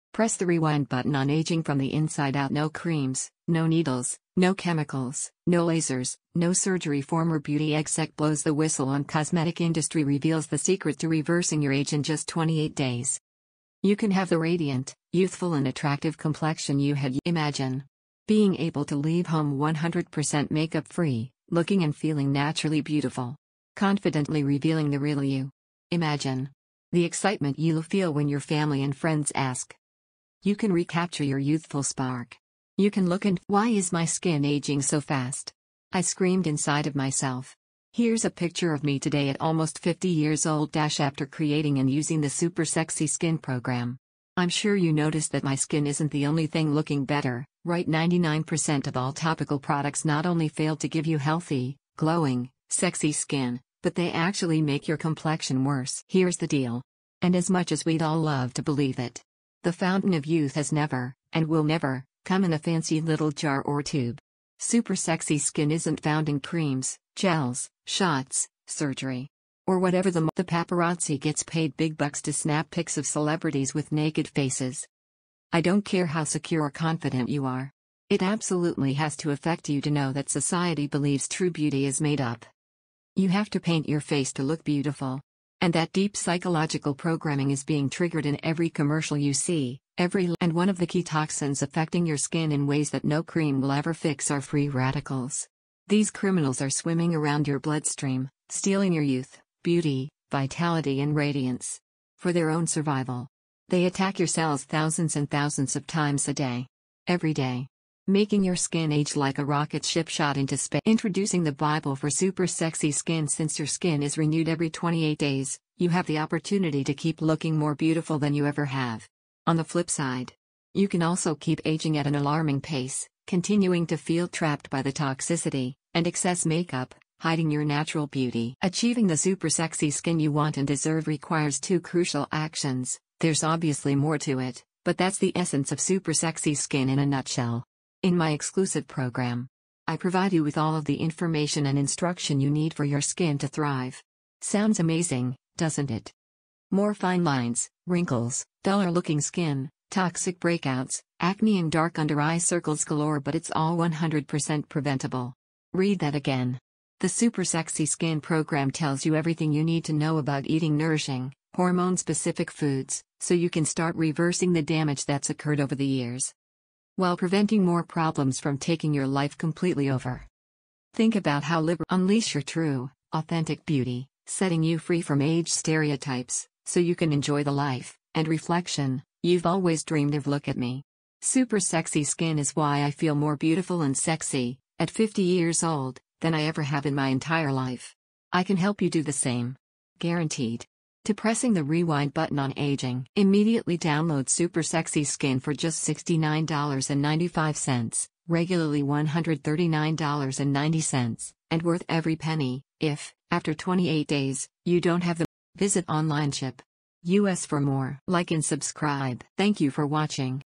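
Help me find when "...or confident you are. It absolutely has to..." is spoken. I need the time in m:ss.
1:16.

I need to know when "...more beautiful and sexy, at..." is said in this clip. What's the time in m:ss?
3:03.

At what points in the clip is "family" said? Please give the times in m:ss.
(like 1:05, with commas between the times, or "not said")
0:28.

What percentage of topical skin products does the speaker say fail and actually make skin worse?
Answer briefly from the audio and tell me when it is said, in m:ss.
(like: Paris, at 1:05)
99%, at 0:47.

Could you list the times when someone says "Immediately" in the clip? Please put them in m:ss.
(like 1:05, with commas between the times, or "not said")
3:13.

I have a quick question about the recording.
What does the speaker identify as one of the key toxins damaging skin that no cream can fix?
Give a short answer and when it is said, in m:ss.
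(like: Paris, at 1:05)
Free radicals, at 1:34.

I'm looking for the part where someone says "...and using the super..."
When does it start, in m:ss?
0:41.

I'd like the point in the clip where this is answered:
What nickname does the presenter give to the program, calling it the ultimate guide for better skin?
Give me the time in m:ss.
1:51.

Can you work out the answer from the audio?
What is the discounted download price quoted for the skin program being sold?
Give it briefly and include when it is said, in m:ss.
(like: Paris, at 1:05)
$69.95, at 3:15.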